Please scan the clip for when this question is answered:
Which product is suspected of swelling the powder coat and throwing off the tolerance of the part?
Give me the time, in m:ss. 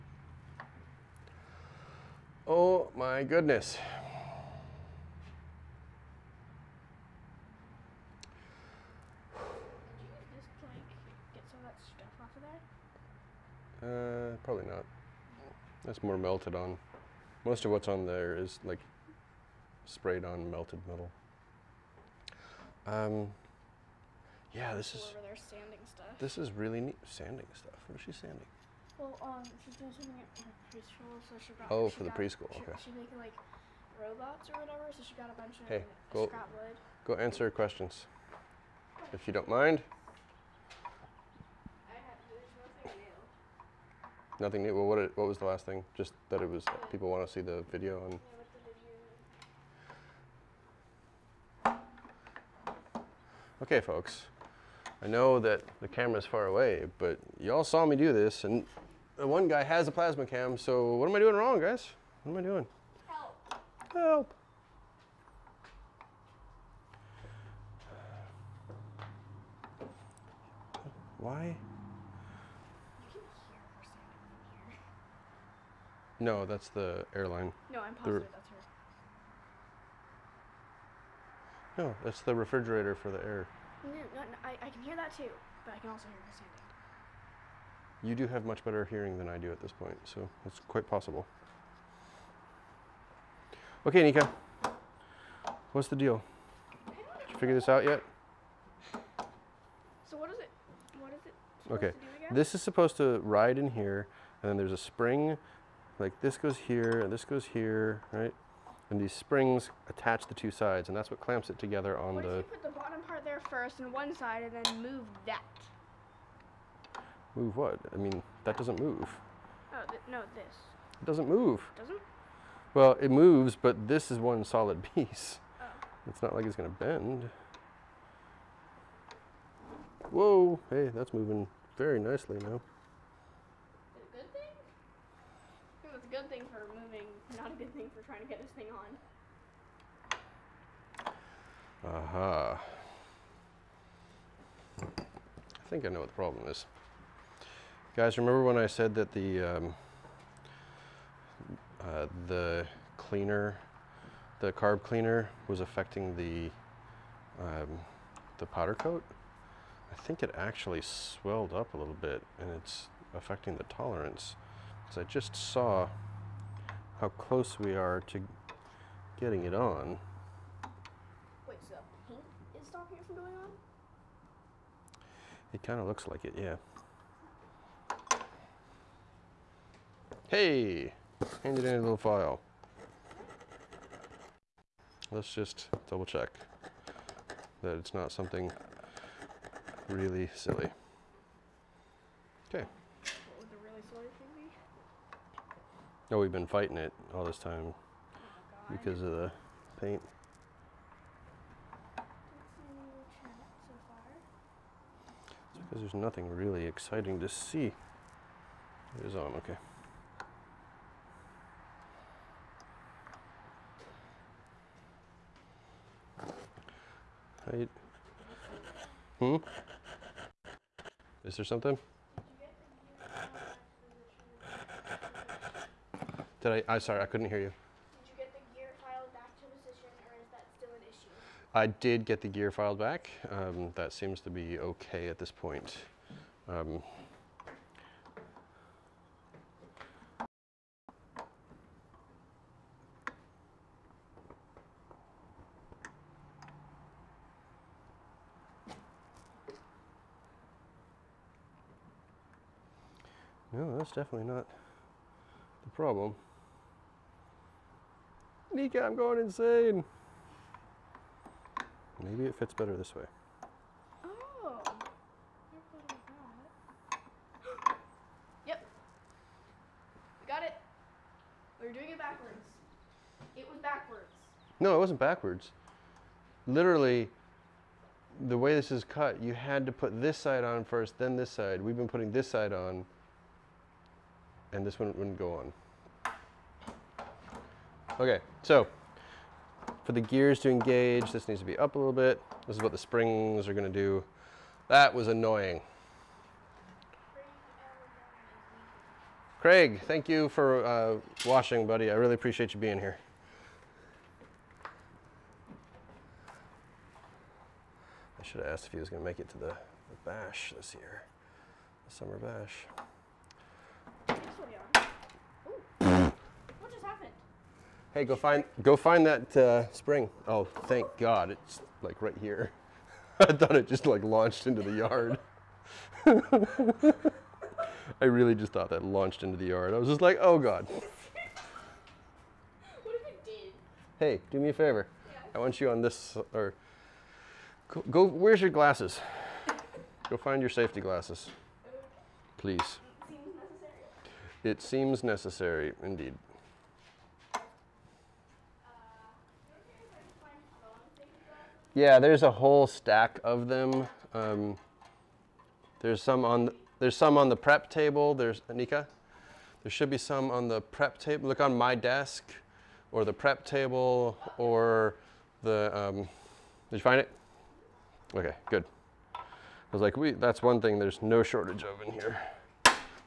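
2:34.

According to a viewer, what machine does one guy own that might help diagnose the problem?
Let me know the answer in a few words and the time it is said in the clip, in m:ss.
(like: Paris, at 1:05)
PlasmaCam, at 0:59.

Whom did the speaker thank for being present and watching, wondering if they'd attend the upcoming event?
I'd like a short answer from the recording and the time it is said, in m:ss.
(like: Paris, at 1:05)
Craig, at 4:59.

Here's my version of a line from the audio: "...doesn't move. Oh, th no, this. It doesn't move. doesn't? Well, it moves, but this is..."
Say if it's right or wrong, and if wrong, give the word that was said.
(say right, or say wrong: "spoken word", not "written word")
right.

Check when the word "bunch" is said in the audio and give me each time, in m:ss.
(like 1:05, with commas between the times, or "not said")
0:35.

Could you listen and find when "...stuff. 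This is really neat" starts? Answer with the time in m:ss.
0:25.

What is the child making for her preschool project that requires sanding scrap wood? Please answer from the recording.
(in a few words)
robots.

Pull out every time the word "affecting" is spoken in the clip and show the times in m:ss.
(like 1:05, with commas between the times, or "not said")
2:35, 2:43.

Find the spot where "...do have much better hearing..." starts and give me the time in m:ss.
1:28.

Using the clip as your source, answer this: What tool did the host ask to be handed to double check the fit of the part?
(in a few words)
file.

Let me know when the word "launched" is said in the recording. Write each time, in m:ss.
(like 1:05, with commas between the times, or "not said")
5:24, 5:28.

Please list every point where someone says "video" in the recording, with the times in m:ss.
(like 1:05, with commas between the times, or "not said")
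0:47.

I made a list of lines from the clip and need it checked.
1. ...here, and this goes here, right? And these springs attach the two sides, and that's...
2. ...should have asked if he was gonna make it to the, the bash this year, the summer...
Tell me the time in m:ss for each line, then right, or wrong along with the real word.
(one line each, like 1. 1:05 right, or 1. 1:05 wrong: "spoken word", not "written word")
1. 1:46 right
2. 5:08 right.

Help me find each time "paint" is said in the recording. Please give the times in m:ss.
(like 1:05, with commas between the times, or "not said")
2:52, 3:19.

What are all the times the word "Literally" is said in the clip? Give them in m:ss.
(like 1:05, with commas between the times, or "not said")
4:36.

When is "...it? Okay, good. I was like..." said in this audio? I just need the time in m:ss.
6:06.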